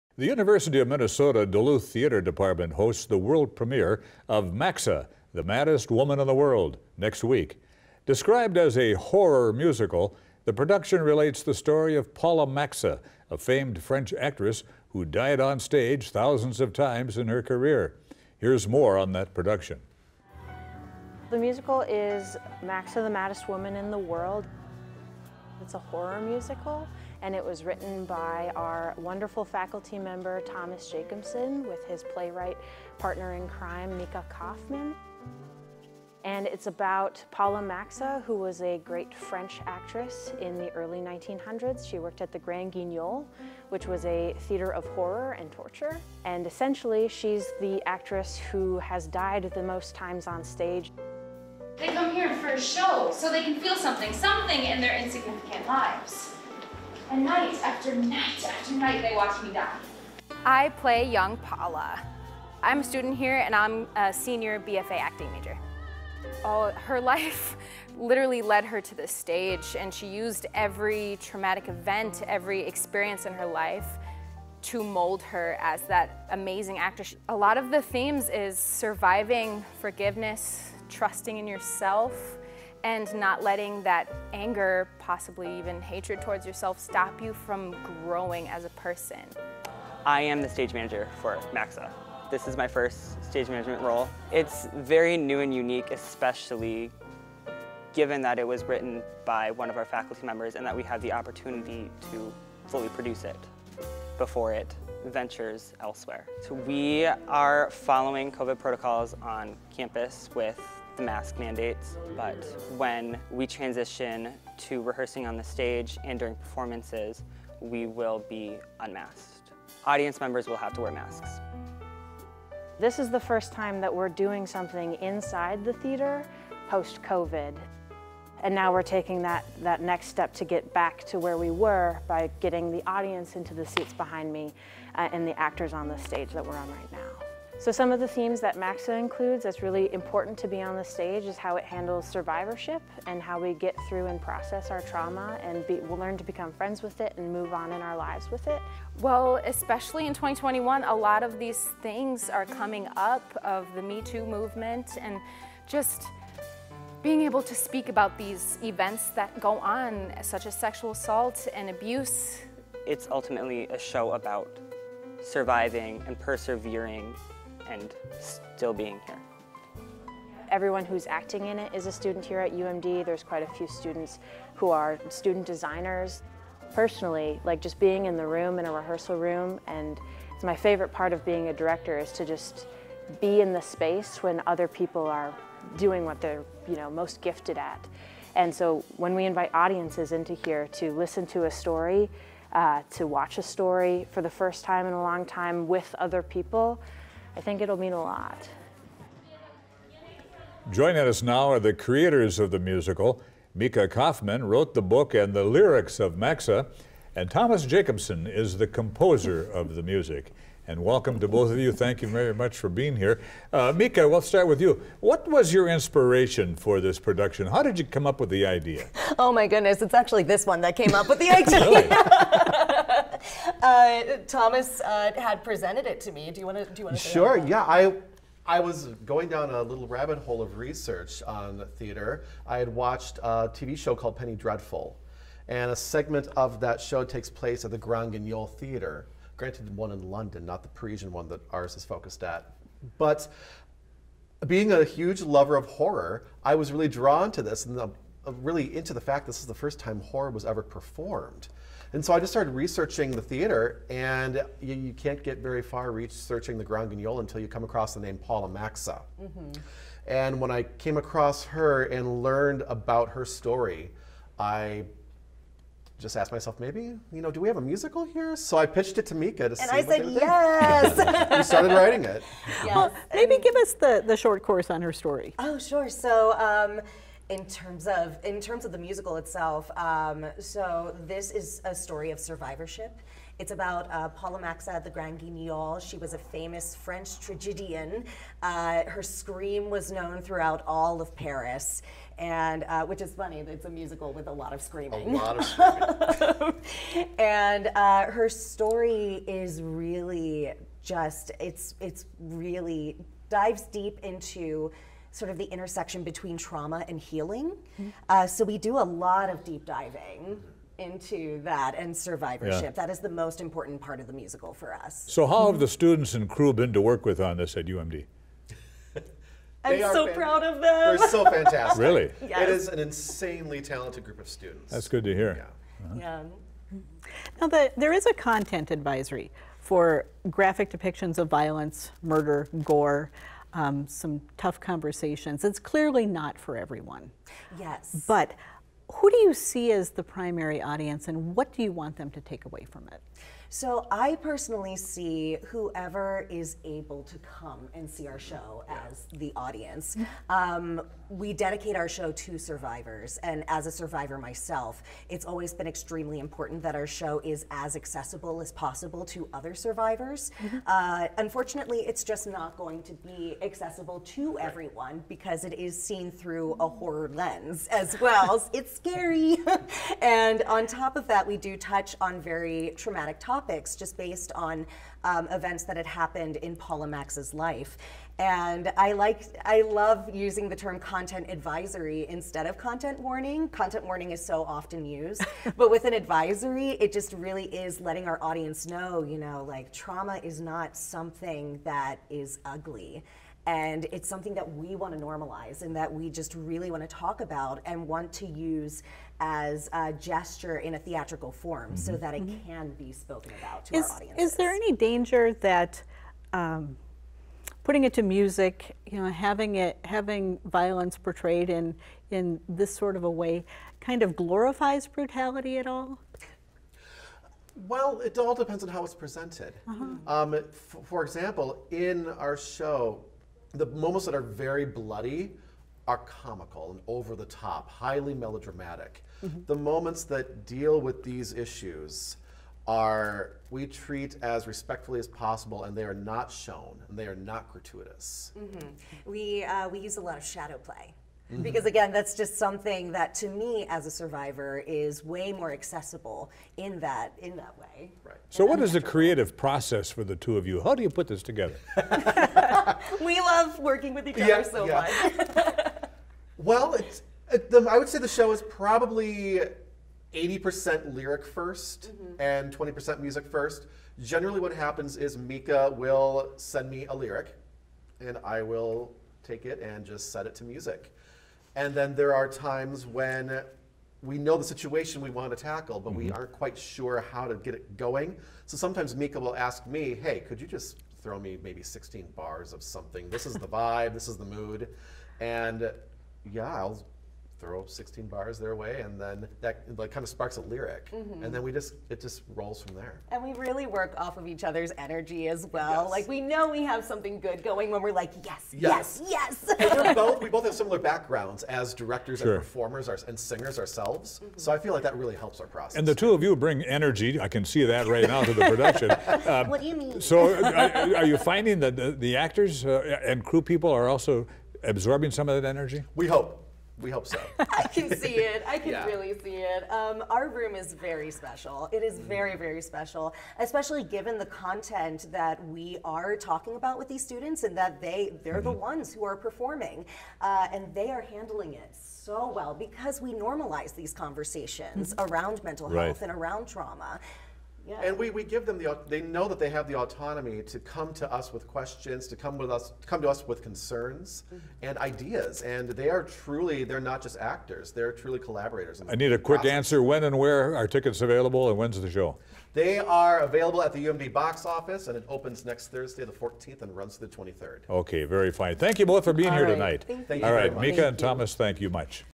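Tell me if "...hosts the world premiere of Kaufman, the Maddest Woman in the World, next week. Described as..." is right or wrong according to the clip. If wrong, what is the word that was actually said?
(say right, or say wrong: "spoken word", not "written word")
wrong: "Maxa", not "Kaufman".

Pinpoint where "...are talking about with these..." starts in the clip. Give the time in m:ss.
8:45.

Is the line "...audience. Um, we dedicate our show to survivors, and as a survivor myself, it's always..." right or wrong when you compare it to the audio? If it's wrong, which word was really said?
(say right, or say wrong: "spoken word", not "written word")
right.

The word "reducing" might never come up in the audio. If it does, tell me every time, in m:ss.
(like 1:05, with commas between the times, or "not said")
not said.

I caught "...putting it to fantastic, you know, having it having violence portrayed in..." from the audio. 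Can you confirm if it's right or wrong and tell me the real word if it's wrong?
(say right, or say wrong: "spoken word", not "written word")
wrong: "music", not "fantastic".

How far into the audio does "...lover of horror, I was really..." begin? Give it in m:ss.
4:05.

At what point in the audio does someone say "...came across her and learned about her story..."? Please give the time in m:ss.
4:20.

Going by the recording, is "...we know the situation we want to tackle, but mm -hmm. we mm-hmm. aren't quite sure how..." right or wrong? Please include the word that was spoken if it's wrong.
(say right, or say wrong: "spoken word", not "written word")
right.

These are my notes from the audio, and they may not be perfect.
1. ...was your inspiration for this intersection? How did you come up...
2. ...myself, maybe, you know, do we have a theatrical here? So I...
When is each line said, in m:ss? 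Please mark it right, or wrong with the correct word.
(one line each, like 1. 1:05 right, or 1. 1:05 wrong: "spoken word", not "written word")
1. 3:35 wrong: "production", not "intersection"
2. 4:26 wrong: "musical", not "theatrical".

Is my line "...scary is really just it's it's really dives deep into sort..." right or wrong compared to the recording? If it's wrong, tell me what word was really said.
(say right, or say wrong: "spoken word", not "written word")
wrong: "story", not "scary".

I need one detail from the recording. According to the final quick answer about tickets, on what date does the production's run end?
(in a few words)
the 23rd.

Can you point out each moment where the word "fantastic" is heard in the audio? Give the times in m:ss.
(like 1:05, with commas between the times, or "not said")
5:21.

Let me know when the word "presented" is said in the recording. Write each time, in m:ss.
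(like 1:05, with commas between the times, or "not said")
3:45, 6:58.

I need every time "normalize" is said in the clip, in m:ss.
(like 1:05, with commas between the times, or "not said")
6:34, 8:53.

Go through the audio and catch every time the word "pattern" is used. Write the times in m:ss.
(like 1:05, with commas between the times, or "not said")
not said.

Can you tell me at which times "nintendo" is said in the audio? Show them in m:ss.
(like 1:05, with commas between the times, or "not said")
not said.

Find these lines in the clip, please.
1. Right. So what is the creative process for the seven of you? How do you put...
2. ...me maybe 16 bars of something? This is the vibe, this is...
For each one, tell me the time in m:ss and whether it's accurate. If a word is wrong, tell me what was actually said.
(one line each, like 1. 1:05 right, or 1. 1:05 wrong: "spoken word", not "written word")
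1. 7:28 wrong: "two", not "seven"
2. 8:01 right.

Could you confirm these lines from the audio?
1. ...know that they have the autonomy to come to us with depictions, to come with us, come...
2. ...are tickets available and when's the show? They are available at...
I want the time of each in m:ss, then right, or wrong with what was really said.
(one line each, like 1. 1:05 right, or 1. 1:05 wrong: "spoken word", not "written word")
1. 8:59 wrong: "questions", not "depictions"
2. 9:10 right.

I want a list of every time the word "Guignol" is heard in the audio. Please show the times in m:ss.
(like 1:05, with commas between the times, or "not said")
0:42, 3:58, 4:16, 4:45.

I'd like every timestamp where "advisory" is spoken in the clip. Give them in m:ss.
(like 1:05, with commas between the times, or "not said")
5:28, 6:21, 6:25.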